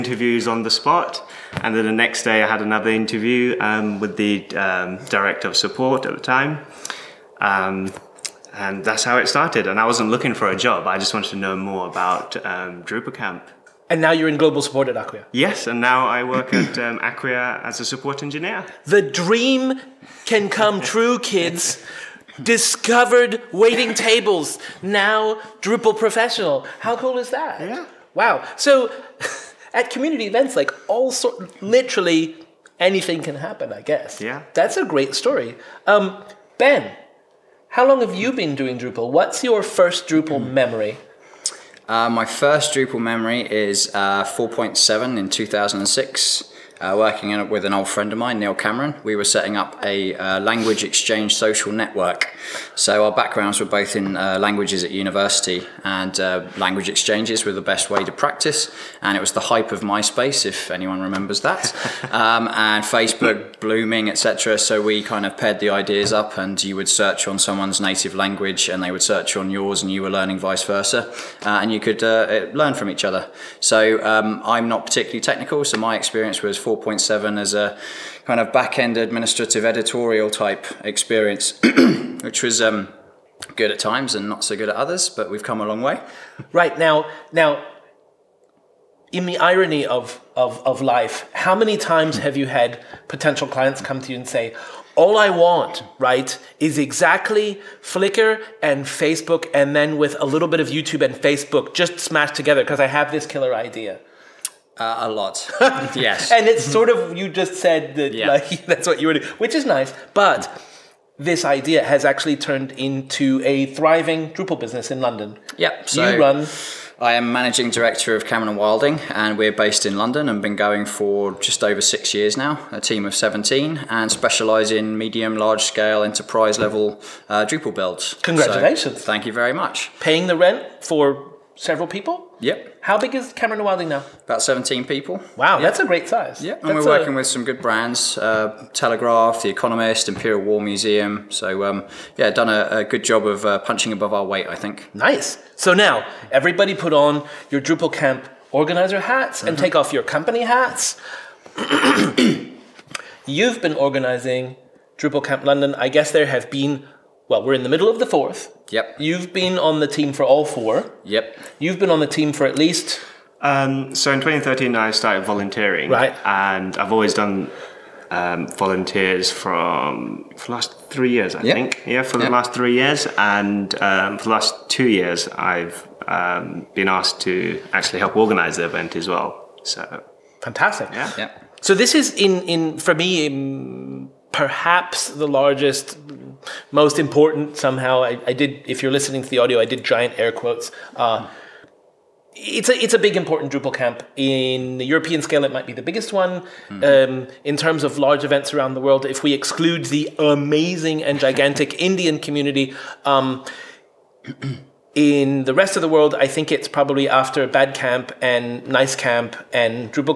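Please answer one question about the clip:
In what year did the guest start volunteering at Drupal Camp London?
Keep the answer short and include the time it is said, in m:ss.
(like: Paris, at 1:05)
2013, at 2:44.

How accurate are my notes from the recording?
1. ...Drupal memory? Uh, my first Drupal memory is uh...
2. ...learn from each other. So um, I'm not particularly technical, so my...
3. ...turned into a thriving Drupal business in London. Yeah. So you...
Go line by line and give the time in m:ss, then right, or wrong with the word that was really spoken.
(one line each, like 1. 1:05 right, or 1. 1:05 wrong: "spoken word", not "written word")
1. 0:40 right
2. 1:12 right
3. 1:52 right.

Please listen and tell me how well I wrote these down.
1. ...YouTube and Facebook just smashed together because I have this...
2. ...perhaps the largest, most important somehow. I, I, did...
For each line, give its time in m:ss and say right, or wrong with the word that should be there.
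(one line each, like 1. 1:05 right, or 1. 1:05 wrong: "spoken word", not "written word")
1. 1:40 right
2. 3:04 right.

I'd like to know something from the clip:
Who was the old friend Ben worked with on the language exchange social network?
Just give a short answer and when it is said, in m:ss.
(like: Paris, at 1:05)
Neil Cameron, at 0:48.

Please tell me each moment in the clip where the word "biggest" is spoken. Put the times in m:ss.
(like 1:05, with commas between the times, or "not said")
3:15.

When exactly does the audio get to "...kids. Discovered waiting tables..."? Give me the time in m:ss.
0:21.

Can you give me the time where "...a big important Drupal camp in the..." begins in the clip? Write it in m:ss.
3:12.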